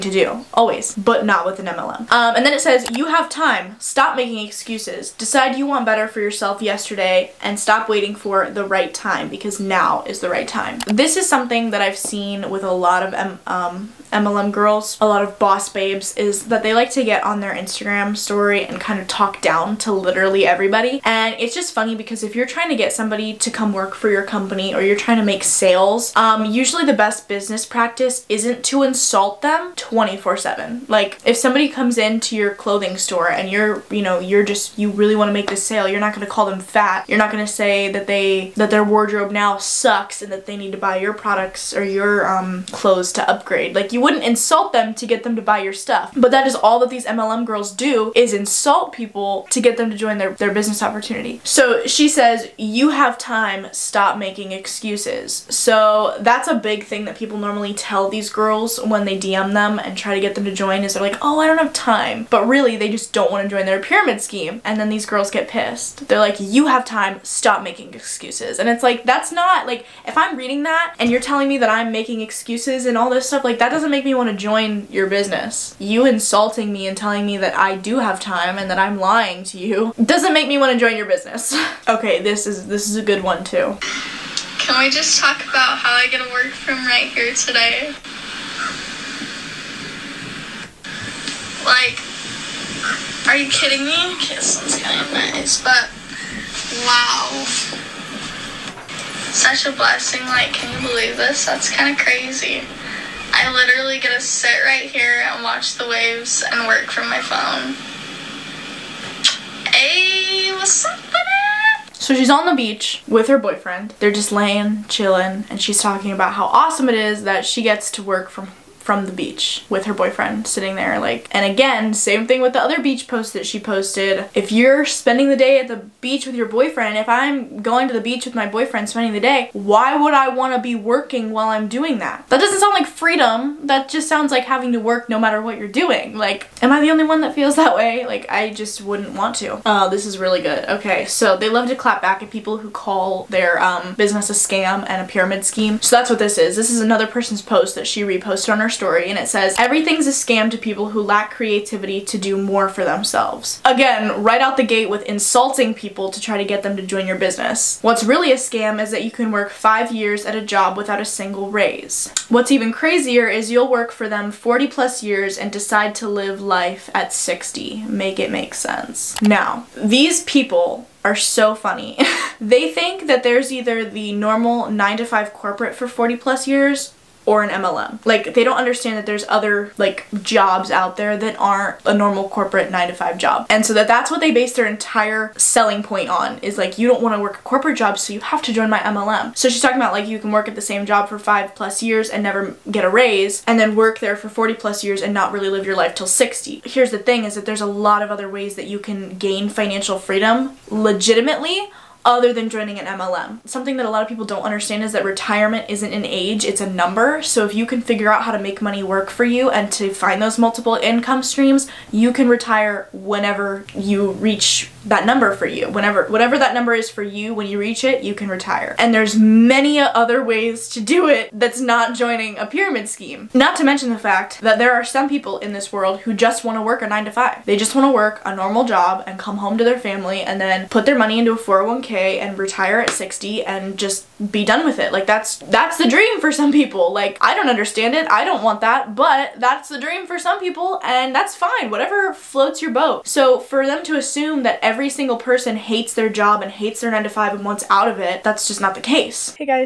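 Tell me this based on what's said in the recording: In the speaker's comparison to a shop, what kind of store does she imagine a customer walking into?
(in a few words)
clothing store.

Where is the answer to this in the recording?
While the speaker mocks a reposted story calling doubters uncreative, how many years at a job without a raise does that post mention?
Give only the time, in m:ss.
2:39.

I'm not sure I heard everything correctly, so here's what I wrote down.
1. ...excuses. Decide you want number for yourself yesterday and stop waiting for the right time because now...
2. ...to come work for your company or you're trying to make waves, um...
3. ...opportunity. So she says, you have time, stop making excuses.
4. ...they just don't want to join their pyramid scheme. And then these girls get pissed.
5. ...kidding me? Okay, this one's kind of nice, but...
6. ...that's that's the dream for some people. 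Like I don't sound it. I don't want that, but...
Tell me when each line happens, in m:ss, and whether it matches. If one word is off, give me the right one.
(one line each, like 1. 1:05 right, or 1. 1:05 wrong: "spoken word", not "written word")
1. 0:04 wrong: "better", not "number"
2. 0:23 wrong: "sales", not "waves"
3. 0:50 right
4. 1:02 right
5. 1:33 right
6. 3:55 wrong: "understand", not "sound".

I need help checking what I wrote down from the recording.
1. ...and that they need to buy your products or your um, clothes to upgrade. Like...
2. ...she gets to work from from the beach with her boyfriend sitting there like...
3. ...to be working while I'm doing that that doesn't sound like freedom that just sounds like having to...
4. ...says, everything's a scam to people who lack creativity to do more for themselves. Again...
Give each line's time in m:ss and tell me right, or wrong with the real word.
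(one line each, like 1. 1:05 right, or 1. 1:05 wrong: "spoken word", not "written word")
1. 0:40 right
2. 1:57 right
3. 2:10 right
4. 2:29 right.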